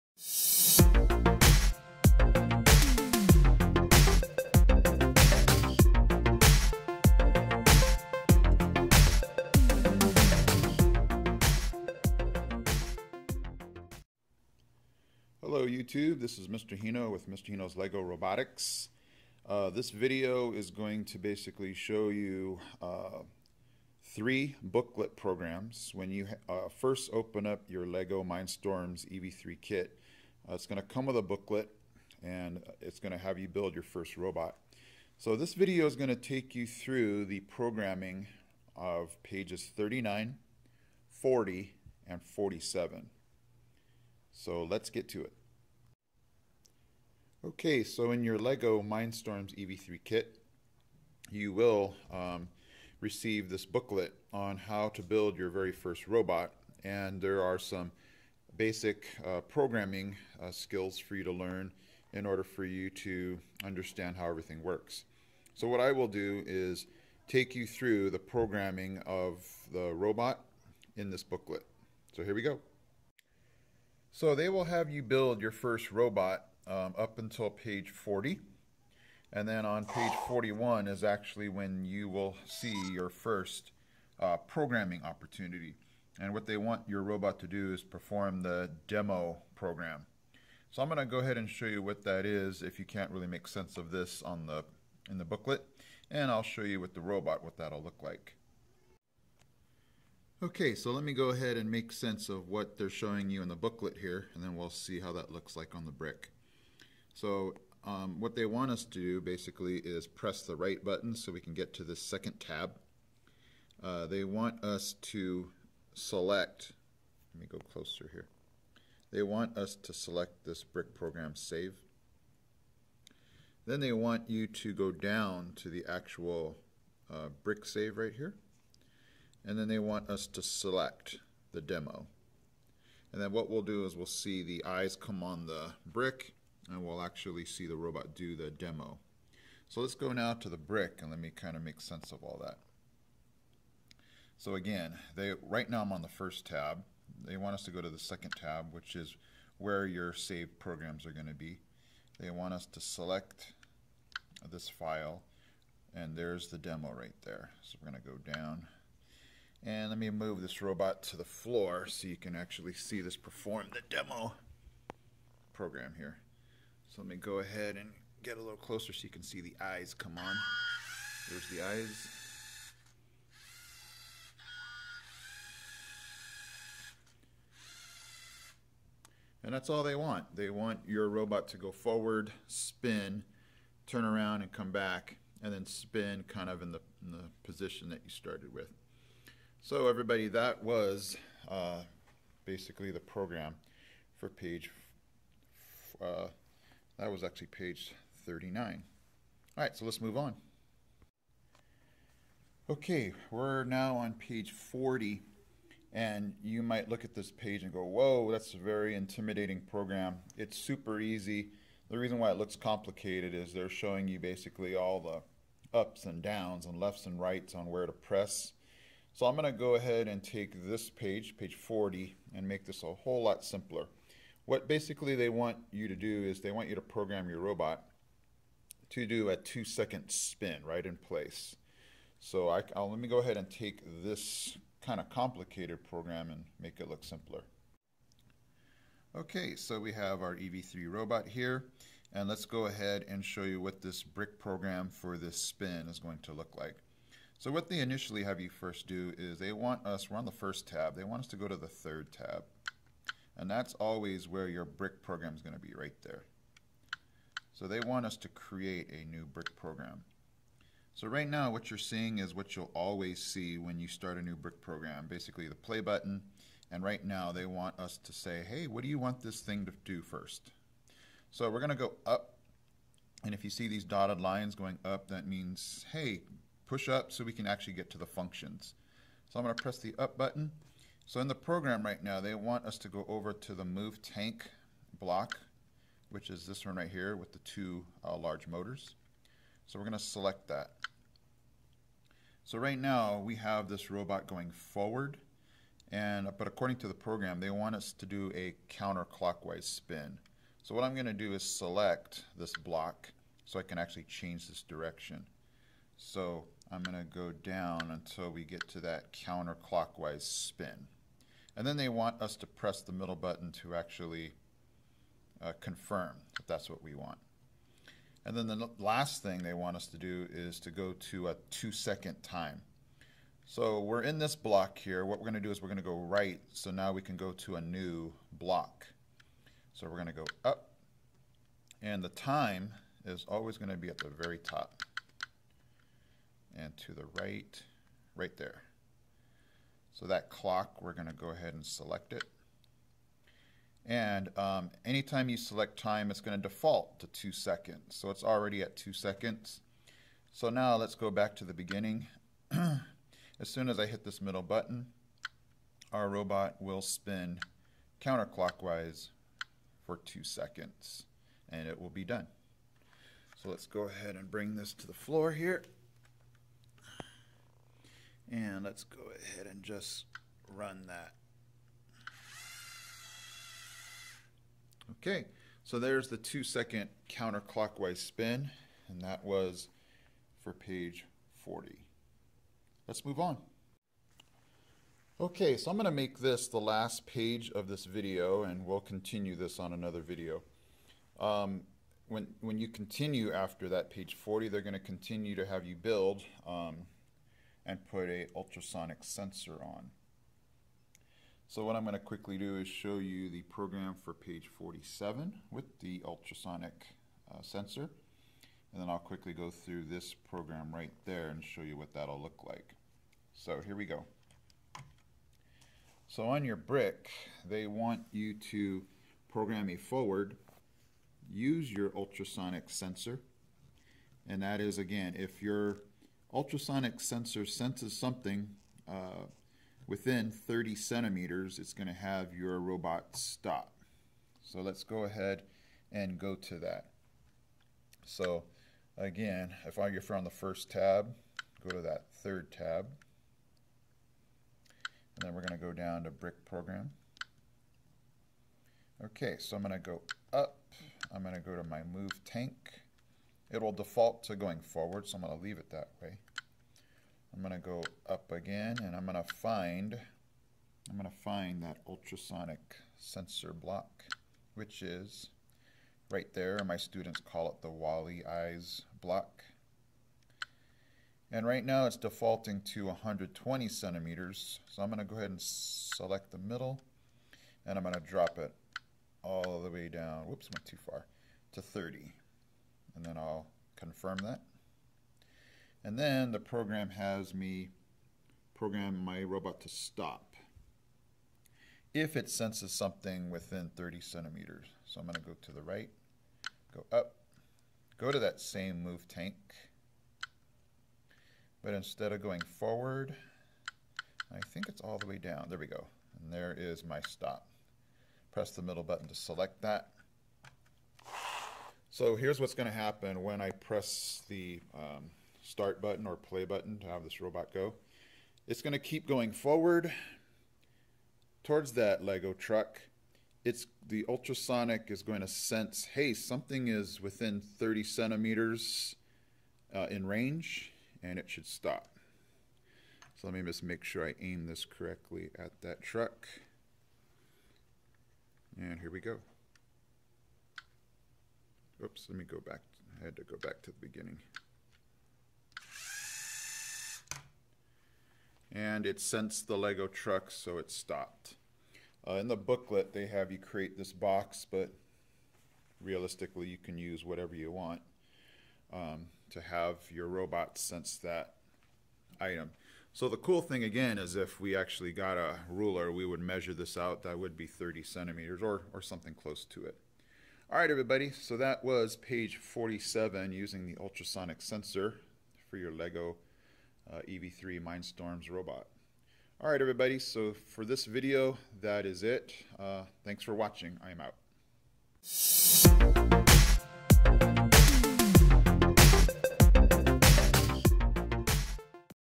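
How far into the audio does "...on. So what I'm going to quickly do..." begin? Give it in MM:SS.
06:39.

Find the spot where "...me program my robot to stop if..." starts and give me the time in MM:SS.
08:07.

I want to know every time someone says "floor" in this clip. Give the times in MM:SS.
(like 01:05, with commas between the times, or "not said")
02:41, 06:04.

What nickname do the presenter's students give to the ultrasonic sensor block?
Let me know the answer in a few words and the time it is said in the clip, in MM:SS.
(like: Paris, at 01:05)
Wally Eyes block, at 07:47.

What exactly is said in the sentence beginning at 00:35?
So this video is going to take you through the programming of pages 39, 40, and 47.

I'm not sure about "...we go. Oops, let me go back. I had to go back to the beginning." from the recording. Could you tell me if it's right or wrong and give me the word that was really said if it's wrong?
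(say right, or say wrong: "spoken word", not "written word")
right.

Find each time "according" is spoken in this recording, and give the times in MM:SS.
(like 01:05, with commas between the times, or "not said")
04:56.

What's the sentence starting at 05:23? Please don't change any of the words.
So we're in this block here.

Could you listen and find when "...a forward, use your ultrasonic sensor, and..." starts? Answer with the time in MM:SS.
06:59.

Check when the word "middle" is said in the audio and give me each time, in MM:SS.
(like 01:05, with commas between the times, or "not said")
05:12, 05:54, 07:56, 08:28.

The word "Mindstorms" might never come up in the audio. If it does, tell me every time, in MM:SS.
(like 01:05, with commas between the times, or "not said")
00:28, 00:48, 09:37.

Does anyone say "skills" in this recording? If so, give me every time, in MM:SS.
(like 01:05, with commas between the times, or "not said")
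01:00.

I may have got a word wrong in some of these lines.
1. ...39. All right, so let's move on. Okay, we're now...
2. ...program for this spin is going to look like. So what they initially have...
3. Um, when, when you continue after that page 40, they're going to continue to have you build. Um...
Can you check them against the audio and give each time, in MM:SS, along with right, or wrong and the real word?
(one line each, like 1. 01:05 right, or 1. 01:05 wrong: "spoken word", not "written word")
1. 03:18 right
2. 04:04 right
3. 06:31 right.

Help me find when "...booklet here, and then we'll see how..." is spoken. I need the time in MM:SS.
01:43.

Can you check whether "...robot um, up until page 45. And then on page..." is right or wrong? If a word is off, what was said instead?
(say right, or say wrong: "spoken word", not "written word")
wrong: "40", not "45".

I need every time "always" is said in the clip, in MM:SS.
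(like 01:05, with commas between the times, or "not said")
04:13, 04:22, 05:33.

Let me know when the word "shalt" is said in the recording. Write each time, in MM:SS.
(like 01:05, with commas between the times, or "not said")
not said.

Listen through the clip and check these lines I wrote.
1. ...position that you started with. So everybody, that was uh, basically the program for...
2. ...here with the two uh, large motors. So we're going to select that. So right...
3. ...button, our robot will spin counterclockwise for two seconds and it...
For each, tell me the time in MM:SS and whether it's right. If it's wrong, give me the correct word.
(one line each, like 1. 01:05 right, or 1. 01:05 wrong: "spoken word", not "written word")
1. 03:07 right
2. 04:46 right
3. 05:54 right.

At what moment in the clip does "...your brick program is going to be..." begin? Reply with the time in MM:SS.
04:14.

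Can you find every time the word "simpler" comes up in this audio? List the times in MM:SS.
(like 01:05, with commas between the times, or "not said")
03:43, 03:57.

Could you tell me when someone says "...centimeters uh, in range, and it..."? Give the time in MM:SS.
08:47.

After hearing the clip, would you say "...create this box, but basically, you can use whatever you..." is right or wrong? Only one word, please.
wrong.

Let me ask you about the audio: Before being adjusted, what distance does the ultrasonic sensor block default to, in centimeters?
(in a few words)
120.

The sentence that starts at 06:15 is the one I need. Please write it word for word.
Okay, so there's the two second counterclockwise spin, and that was for page 40.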